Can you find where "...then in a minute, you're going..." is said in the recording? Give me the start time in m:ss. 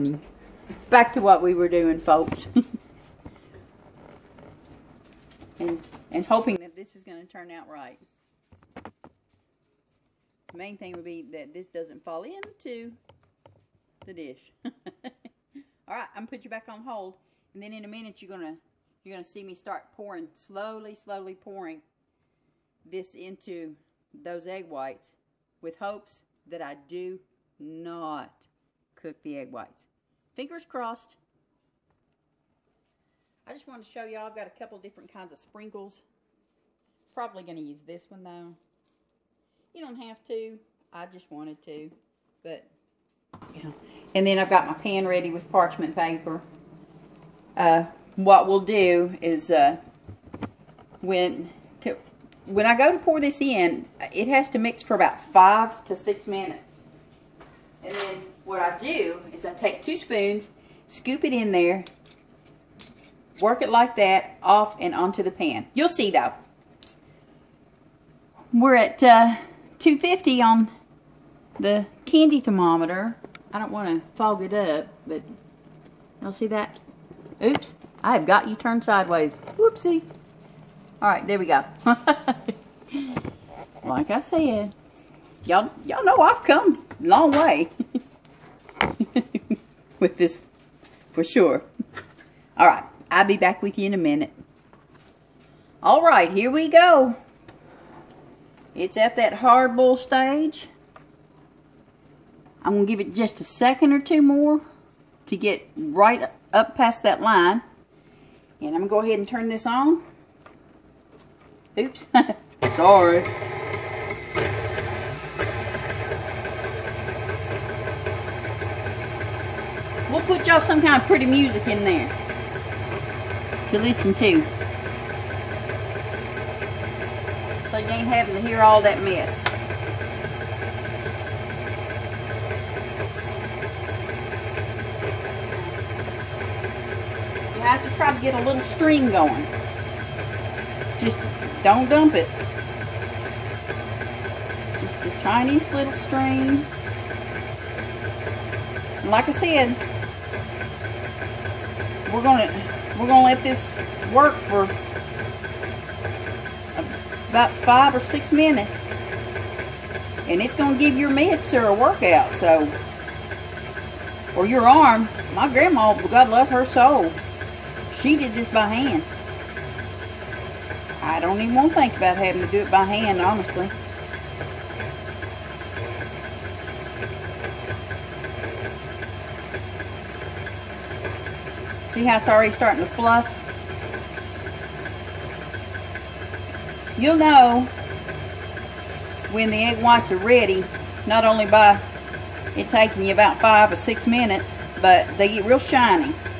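0:17.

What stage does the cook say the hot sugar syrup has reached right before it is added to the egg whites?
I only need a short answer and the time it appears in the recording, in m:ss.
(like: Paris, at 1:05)
hardball stage, at 1:39.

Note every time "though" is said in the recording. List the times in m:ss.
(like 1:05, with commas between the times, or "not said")
0:38, 1:06.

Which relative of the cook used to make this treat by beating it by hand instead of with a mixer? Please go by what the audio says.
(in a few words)
grandma.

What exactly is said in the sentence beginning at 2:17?
You have to try to get a little stream going.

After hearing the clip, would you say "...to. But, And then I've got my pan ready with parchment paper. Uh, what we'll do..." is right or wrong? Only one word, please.
right.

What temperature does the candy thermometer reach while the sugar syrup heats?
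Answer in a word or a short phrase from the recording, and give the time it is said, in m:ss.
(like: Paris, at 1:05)
250, at 1:09.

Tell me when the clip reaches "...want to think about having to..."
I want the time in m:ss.
2:51.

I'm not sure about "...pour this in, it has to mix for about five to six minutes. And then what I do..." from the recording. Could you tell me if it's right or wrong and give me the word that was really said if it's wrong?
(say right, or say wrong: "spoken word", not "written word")
right.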